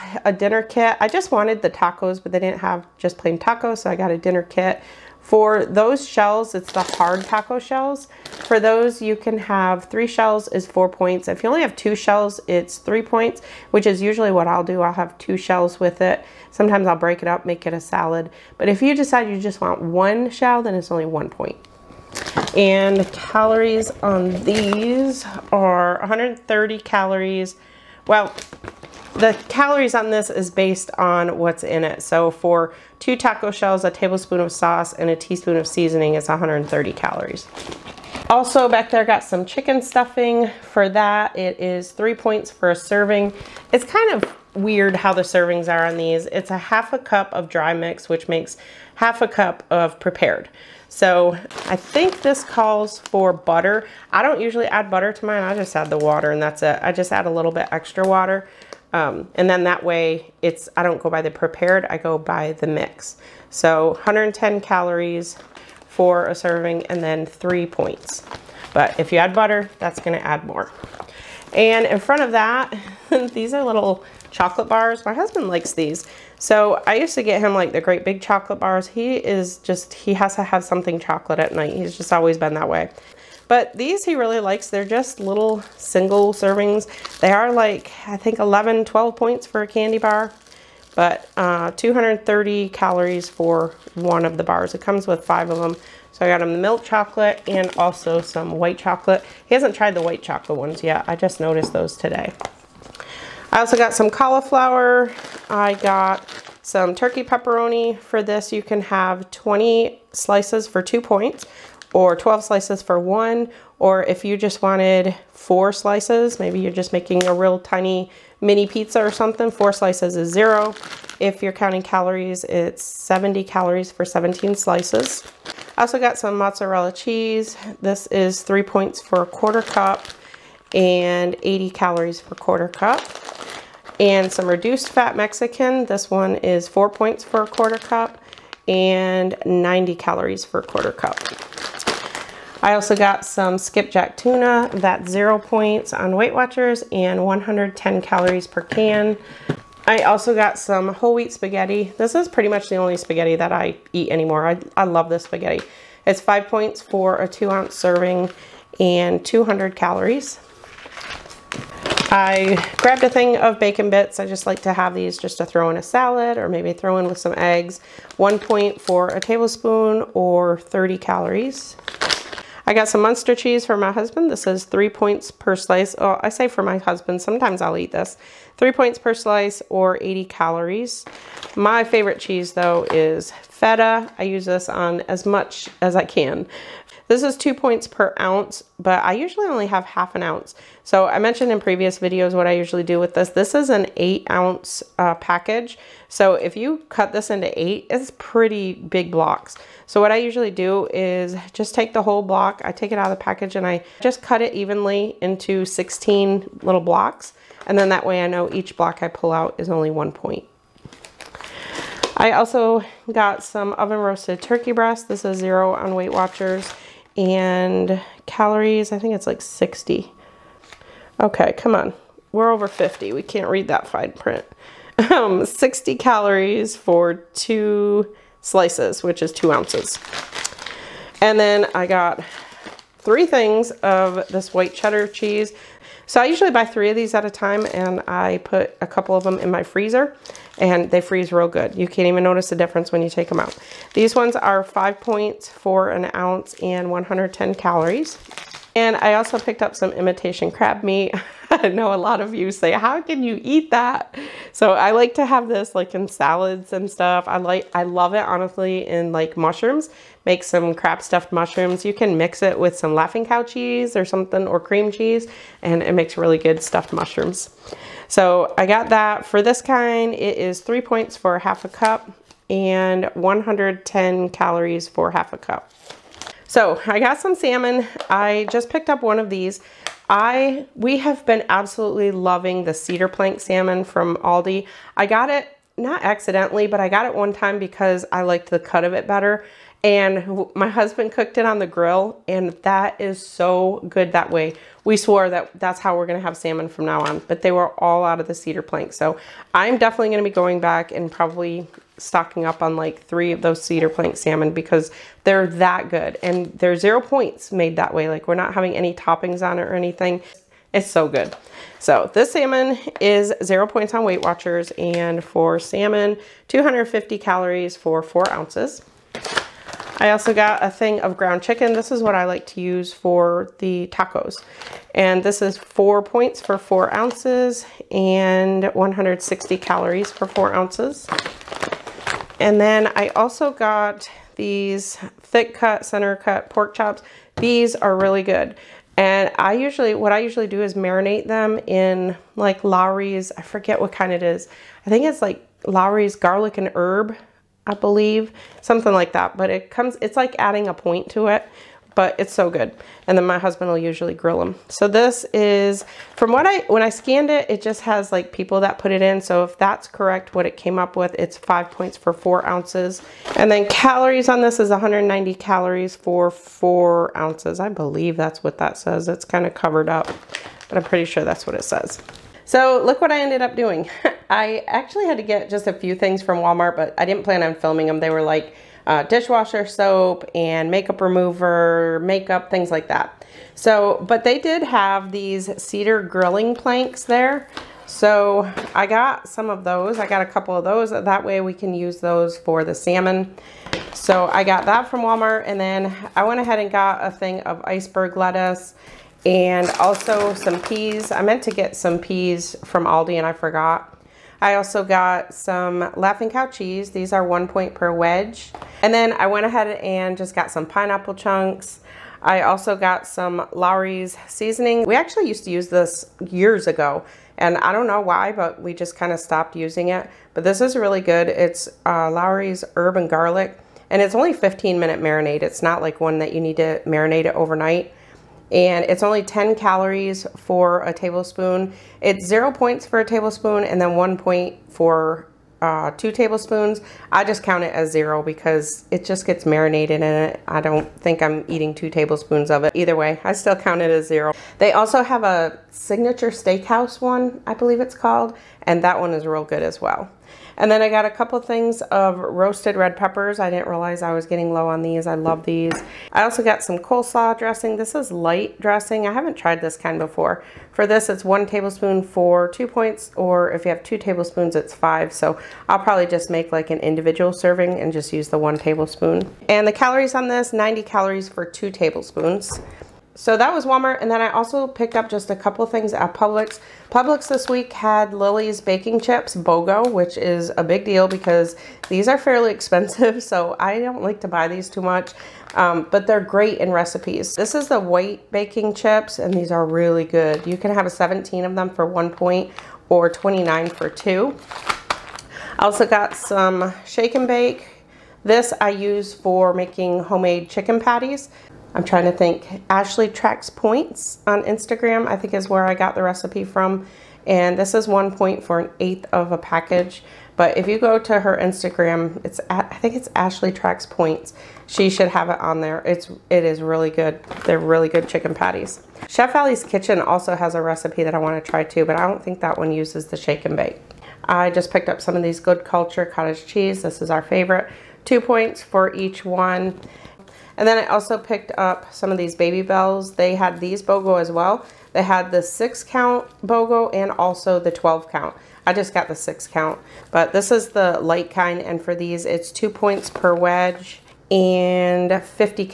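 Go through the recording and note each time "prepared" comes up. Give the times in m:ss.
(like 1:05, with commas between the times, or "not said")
0:49, 1:01.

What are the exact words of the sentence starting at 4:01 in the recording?
You can't even notice the difference when you take them out.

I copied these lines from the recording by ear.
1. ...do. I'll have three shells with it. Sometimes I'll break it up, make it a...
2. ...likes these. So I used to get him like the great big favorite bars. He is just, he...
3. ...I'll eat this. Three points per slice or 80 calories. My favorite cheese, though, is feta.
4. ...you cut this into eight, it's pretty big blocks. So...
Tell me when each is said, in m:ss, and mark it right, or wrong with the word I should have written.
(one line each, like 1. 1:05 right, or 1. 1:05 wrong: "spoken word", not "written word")
1. 0:14 wrong: "two", not "three"
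2. 1:15 wrong: "chocolate", not "favorite"
3. 2:57 right
4. 3:16 right.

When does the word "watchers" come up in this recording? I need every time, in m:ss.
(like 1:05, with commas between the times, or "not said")
2:26, 3:36, 5:14.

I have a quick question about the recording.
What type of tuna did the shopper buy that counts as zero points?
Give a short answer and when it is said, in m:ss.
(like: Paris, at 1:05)
skipjack, at 2:23.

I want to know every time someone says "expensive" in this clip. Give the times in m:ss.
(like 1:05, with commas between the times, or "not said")
8:02.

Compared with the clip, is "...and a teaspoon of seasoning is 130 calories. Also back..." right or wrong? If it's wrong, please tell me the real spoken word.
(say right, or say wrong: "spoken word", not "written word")
right.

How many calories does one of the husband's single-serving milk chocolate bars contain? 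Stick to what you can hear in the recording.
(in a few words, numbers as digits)
230.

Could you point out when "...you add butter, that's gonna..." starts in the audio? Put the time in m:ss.
1:09.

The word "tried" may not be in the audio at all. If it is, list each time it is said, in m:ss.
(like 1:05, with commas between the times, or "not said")
1:39, 7:39.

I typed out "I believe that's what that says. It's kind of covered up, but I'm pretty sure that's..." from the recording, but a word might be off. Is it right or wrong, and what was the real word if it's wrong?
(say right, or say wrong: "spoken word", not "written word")
right.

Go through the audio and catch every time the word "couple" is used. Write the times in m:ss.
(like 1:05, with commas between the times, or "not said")
3:58, 6:30, 7:31, 7:55.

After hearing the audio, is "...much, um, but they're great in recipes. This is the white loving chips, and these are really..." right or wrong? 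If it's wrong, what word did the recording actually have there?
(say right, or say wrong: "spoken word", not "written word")
wrong: "baking", not "loving".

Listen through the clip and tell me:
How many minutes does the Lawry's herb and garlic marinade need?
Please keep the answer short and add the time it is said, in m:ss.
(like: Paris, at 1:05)
15, at 7:04.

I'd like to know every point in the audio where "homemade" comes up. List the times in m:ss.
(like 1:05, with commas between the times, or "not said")
8:20.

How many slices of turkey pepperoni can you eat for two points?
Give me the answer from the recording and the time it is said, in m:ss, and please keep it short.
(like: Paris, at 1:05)
20, at 1:48.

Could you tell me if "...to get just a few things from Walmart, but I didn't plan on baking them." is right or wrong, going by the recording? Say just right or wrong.
wrong.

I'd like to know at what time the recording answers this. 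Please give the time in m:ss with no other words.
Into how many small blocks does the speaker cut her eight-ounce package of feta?
3:25.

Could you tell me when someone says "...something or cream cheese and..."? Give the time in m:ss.
4:24.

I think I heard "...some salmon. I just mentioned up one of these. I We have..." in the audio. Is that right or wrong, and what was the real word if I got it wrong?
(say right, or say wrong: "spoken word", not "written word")
wrong: "picked", not "mentioned".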